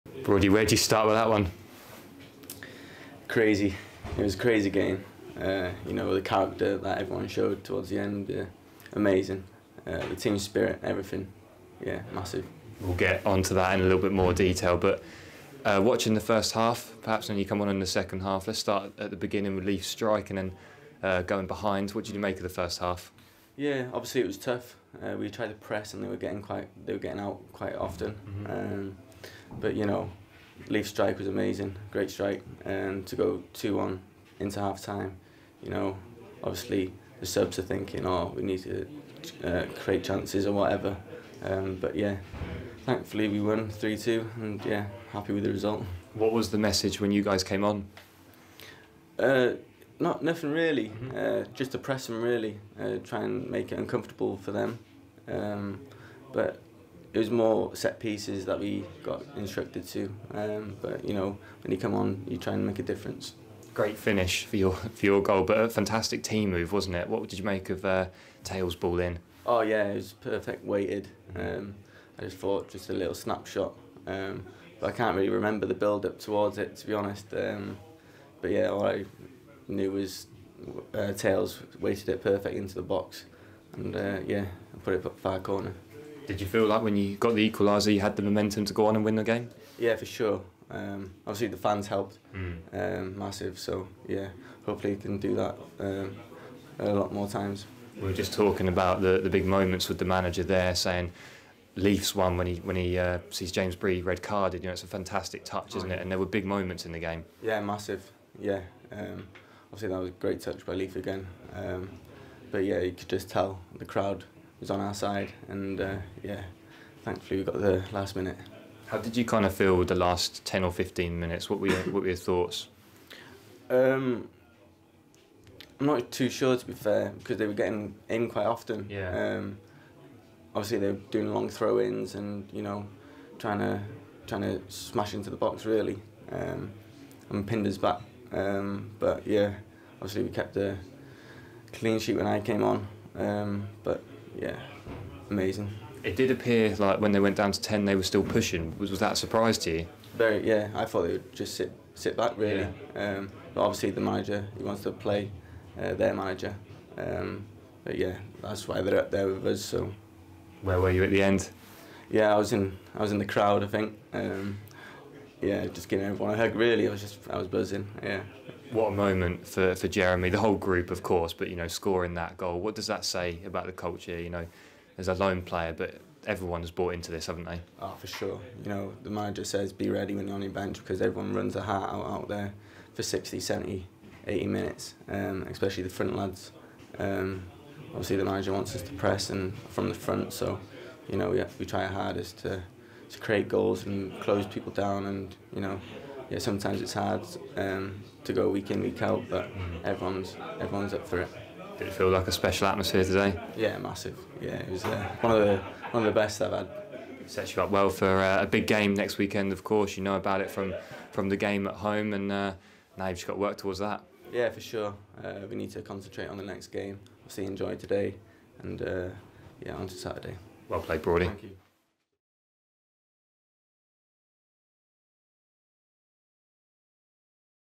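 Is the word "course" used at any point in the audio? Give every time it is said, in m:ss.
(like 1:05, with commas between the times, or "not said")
2:51, 3:29.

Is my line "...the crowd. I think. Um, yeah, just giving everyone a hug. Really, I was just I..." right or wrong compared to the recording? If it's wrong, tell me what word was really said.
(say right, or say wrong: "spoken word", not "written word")
right.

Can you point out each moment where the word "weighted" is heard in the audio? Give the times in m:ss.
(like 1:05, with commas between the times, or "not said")
1:10, 1:21.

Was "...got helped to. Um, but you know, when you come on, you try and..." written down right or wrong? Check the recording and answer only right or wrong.
wrong.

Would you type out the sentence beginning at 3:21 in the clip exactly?
Did it feel like a special atmosphere today?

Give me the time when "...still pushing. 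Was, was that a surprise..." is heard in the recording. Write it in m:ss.
2:28.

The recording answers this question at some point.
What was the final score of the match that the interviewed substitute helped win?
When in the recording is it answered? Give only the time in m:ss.
0:43.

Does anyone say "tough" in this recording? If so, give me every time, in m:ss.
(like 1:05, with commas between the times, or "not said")
0:24.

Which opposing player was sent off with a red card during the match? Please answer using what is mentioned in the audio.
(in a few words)
James Bree.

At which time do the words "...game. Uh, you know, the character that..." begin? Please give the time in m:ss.
0:04.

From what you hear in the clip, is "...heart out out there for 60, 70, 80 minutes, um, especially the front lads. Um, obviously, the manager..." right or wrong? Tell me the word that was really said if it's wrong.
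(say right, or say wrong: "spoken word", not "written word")
right.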